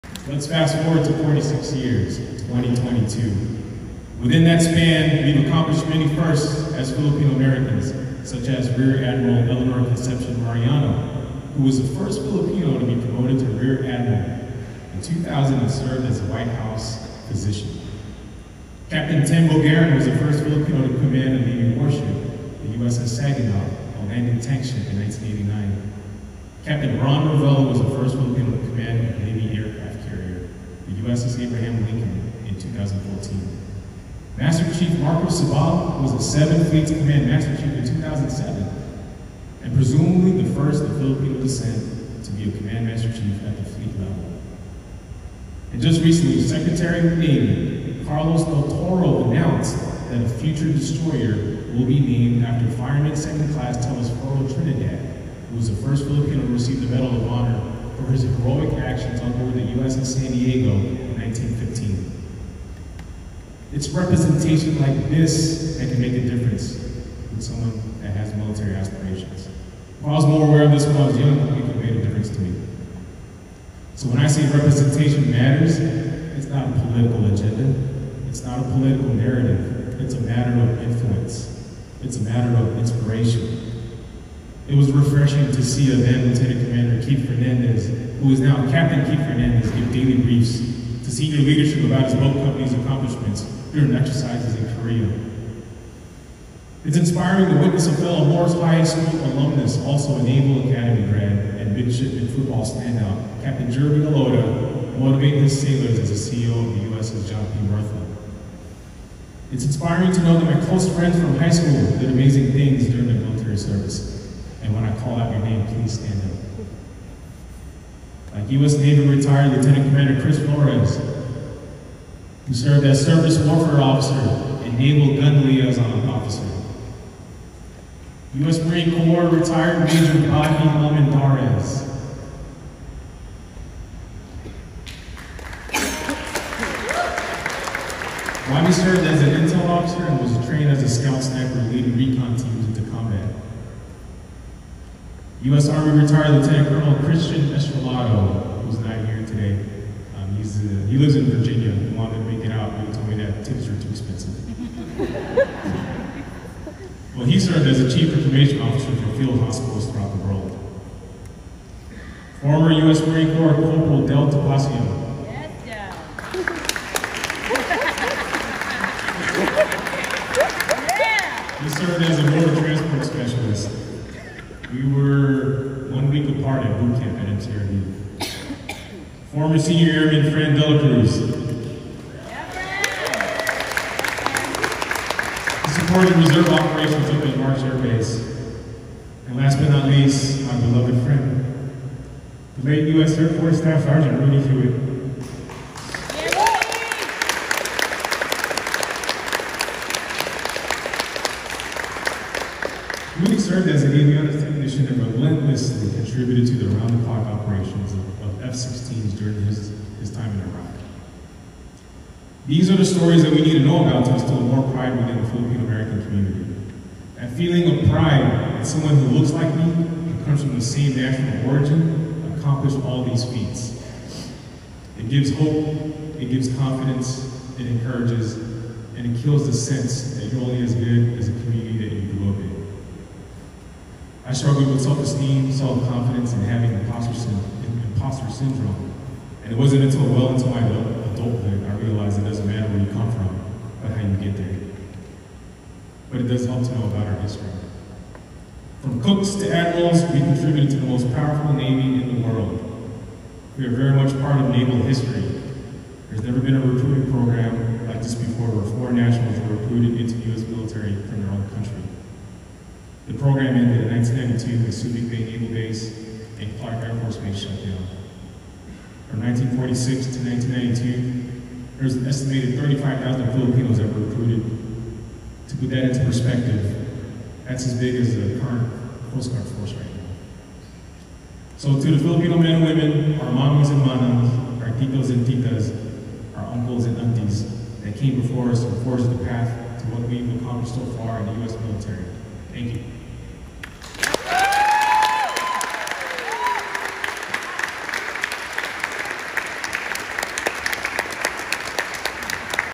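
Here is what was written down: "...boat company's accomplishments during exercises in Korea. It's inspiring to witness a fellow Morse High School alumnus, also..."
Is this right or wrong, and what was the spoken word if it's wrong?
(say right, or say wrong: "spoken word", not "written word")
right.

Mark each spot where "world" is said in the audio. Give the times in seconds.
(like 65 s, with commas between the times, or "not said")
160 s, 252 s.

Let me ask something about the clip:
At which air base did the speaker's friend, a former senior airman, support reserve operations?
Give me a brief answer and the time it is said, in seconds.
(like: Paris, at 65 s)
March Air Base, at 187 s.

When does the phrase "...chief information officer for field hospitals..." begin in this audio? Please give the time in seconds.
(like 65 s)
157 s.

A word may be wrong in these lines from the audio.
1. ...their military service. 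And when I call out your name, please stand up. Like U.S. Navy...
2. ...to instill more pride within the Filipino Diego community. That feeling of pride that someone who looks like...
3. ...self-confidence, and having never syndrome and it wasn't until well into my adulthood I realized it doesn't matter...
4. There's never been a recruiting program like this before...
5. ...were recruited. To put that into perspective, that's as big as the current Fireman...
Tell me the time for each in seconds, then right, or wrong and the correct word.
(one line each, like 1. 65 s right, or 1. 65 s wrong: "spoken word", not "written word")
1. 113 s right
2. 214 s wrong: "American", not "Diego"
3. 235 s wrong: "imposter", not "never"
4. 256 s right
5. 273 s wrong: "Coast", not "Fireman".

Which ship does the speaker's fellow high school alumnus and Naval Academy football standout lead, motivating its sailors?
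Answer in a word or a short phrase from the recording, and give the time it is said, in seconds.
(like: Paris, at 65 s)
USS John P. Murtha, at 106 s.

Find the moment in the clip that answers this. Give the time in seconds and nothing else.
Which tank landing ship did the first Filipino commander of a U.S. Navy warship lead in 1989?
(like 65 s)
22 s.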